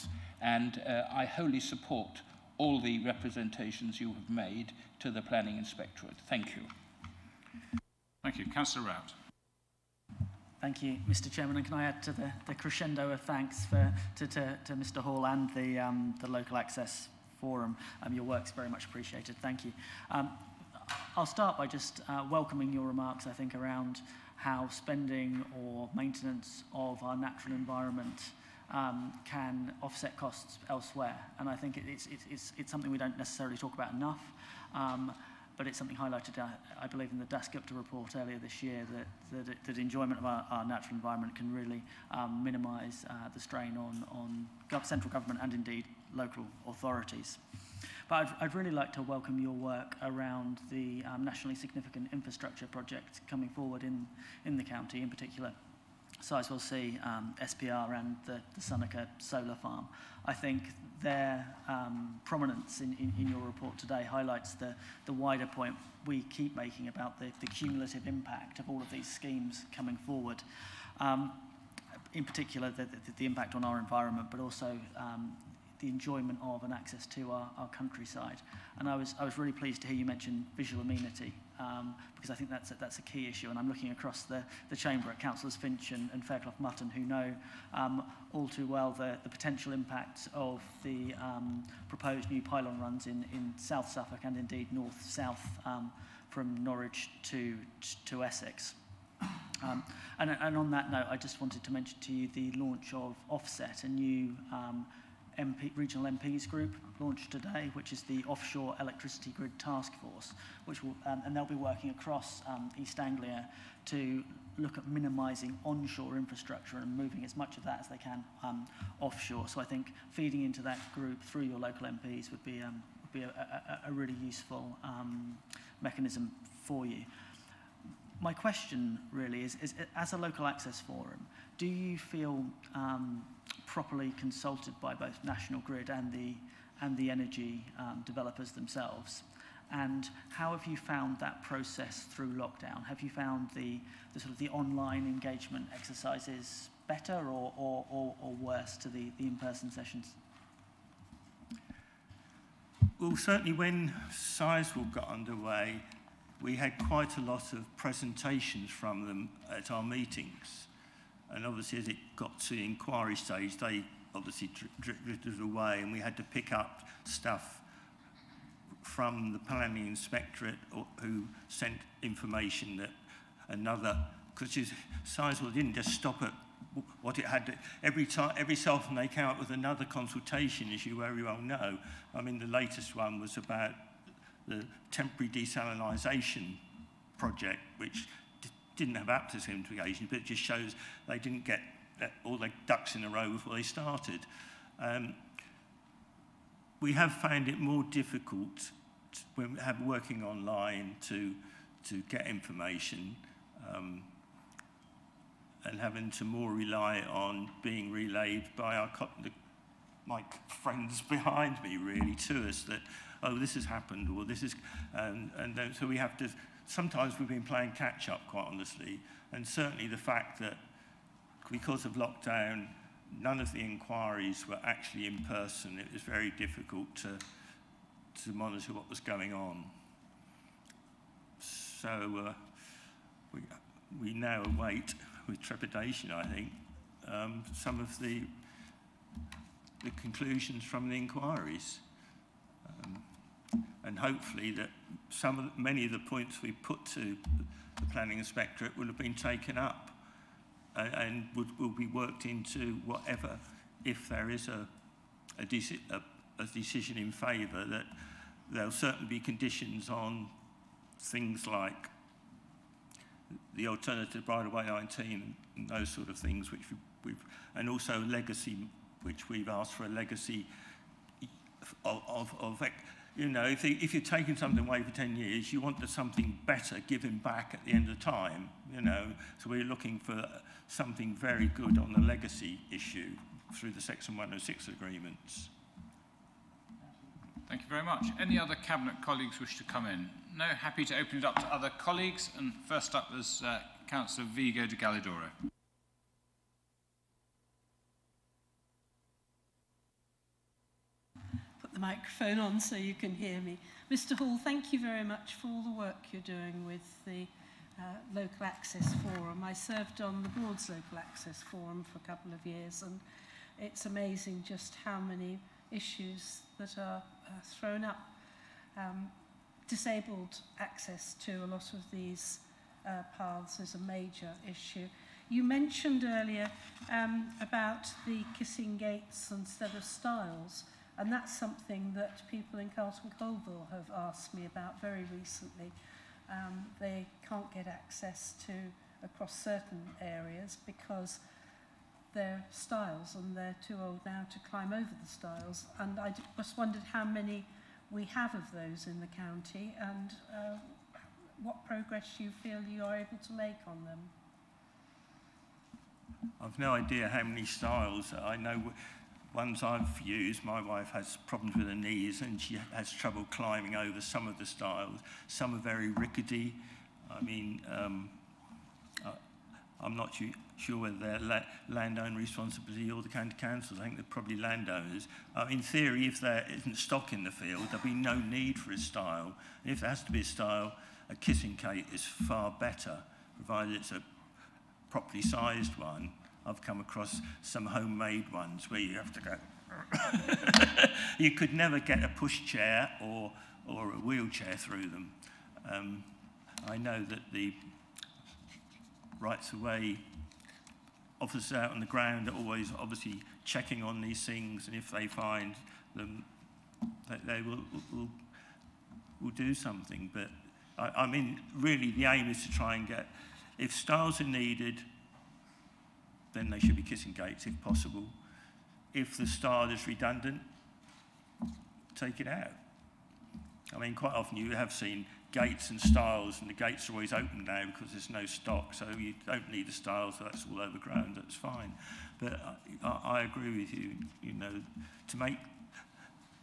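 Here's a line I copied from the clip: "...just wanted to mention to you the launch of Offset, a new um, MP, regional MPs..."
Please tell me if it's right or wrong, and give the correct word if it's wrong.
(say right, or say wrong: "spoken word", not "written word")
right.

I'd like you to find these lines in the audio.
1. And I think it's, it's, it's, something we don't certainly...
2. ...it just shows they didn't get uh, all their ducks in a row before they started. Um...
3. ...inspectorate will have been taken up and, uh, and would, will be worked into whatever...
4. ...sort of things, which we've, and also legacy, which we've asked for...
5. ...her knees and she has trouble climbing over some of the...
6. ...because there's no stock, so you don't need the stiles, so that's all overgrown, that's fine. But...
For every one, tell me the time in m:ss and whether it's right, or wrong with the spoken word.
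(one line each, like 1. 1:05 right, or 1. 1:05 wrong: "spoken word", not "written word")
1. 0:31 wrong: "necessarily", not "certainly"
2. 3:10 right
3. 4:08 right
4. 4:25 right
5. 6:01 right
6. 7:07 right.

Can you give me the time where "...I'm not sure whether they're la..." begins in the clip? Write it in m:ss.
6:09.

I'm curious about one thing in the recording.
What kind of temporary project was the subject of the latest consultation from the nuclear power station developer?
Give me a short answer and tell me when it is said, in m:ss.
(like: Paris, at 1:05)
desalinization, at 3:05.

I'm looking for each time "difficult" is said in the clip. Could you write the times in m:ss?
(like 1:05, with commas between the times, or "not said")
3:17, 3:46.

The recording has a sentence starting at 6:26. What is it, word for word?
I've come across some homemade ones where you have to go.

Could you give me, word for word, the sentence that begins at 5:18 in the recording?
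Um, disabled access to a lot of these uh, paths is a major issue.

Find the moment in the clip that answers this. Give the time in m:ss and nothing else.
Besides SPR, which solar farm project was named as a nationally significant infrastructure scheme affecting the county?
0:58.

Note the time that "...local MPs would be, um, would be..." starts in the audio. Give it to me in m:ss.
2:01.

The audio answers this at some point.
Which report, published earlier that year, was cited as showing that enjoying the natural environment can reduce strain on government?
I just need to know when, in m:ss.
0:37.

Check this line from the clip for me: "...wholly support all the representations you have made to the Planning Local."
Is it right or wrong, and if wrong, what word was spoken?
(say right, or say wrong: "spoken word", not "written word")
wrong: "Inspectorate", not "Local".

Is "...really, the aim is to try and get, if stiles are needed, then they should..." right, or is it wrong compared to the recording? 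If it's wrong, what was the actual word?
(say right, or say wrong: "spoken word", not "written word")
right.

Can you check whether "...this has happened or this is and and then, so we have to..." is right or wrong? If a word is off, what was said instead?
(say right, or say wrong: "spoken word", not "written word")
right.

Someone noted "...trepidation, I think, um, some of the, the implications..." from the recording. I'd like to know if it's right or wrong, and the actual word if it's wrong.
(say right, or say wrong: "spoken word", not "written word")
wrong: "conclusions", not "implications".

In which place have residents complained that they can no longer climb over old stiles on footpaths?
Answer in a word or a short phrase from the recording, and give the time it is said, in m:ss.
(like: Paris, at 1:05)
Carlton Colville, at 5:32.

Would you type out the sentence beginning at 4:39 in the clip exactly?
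So we're looking for something very good on the legacy issue through the Section 106 agreements.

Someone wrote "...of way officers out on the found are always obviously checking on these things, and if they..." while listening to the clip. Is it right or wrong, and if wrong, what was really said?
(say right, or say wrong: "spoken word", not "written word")
wrong: "ground", not "found".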